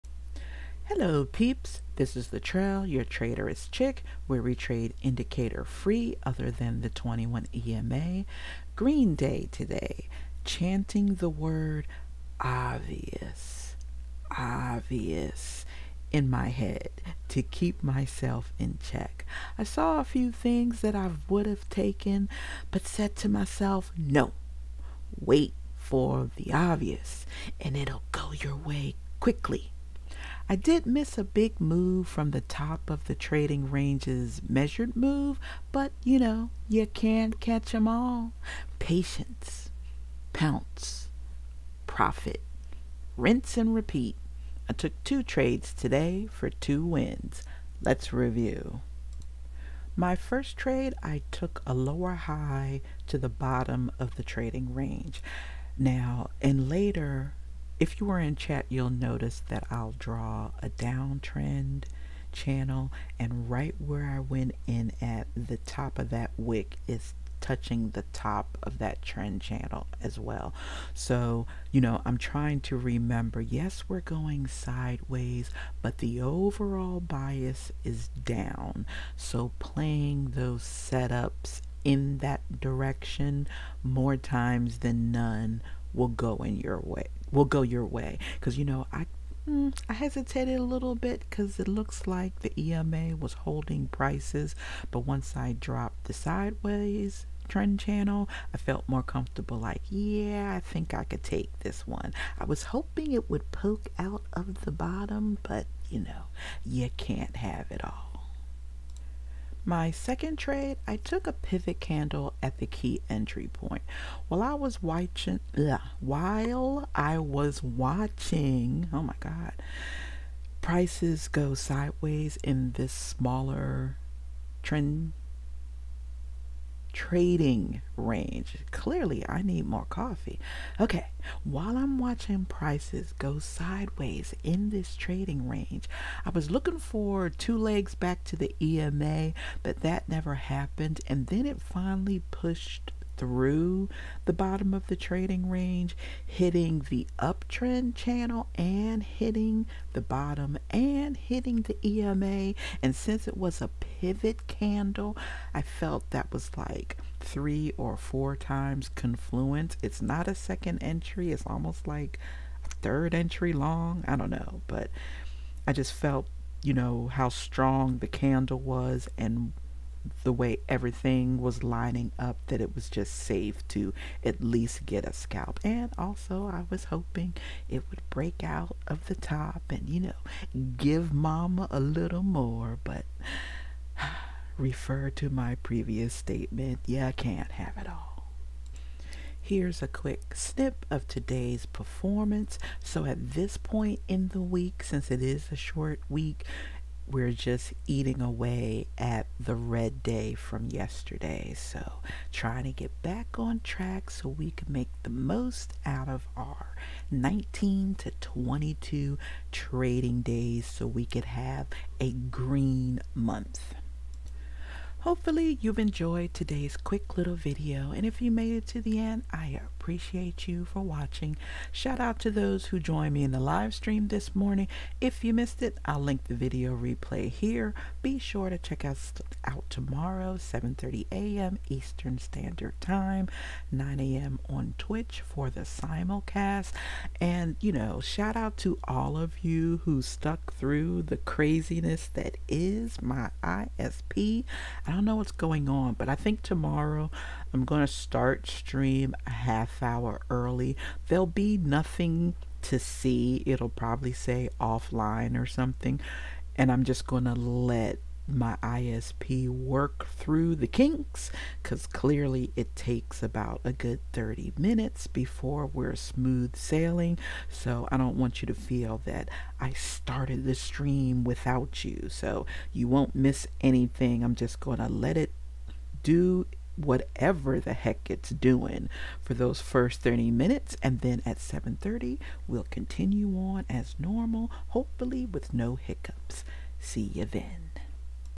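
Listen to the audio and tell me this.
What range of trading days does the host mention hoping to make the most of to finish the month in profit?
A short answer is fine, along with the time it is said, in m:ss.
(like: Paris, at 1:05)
19 to 22, at 3:27.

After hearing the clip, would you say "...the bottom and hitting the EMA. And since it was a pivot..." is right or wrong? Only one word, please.
right.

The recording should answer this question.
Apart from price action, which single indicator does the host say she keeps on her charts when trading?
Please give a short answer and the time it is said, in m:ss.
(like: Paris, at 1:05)
21 EMA, at 0:06.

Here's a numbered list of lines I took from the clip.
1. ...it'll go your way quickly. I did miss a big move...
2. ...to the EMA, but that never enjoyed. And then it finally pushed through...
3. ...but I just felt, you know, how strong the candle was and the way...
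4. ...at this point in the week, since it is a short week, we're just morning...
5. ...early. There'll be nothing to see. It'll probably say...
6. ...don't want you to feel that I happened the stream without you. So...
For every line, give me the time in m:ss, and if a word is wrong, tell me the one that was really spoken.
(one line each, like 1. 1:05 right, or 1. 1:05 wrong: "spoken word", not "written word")
1. 0:27 right
2. 2:18 wrong: "happened", not "enjoyed"
3. 2:44 right
4. 3:13 wrong: "eating", not "morning"
5. 4:10 right
6. 4:27 wrong: "started", not "happened".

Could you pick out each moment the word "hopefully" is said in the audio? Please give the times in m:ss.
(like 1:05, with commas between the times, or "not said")
3:35, 4:44.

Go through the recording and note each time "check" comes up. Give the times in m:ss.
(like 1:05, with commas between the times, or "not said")
0:18, 3:48.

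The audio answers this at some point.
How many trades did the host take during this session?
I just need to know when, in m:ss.
0:45.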